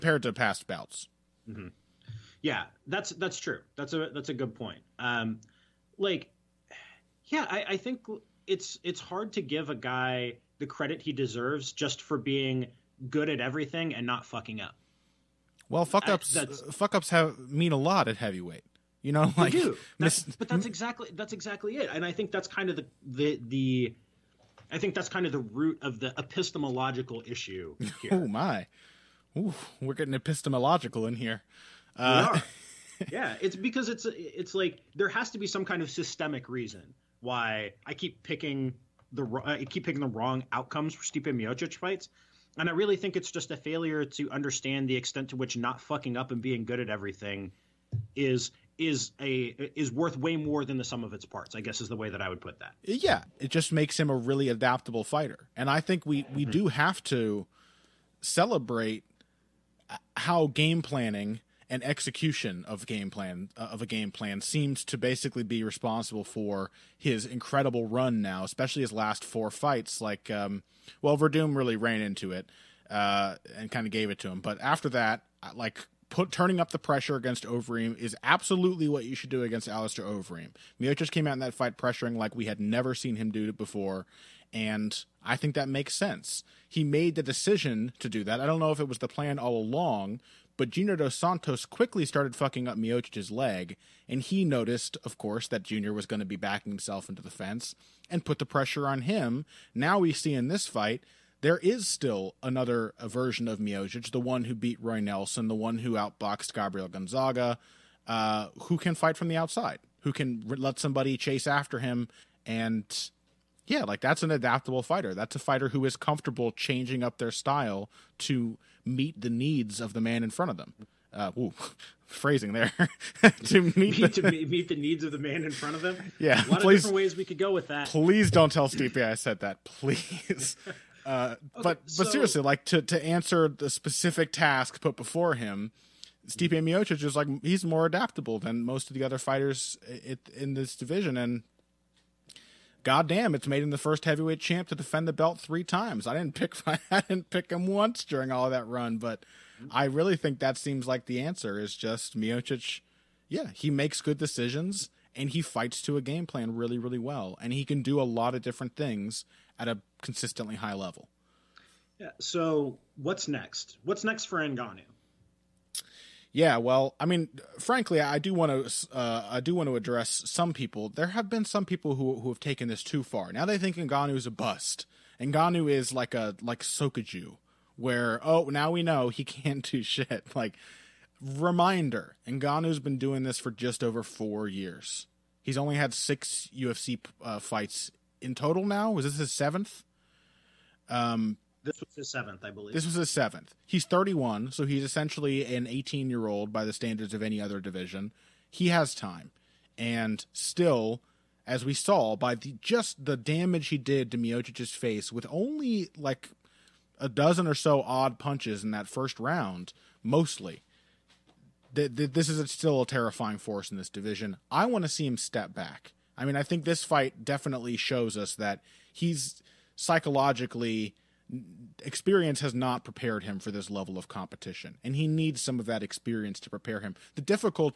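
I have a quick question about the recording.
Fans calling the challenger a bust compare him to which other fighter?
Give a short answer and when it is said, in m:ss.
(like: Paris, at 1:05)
Sokoudjou, at 2:56.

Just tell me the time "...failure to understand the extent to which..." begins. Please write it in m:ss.
0:43.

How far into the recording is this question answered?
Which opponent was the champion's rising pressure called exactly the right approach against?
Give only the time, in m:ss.
1:19.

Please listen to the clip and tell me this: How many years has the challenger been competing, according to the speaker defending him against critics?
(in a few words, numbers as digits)
just over 4 years.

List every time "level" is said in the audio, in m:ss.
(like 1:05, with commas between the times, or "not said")
2:40, 3:43.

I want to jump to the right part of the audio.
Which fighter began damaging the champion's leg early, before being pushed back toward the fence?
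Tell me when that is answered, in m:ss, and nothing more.
1:30.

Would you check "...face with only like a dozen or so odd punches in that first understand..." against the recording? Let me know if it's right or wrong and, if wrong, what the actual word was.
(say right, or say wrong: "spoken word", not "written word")
wrong: "round", not "understand".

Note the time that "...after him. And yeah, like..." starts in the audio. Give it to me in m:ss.
1:51.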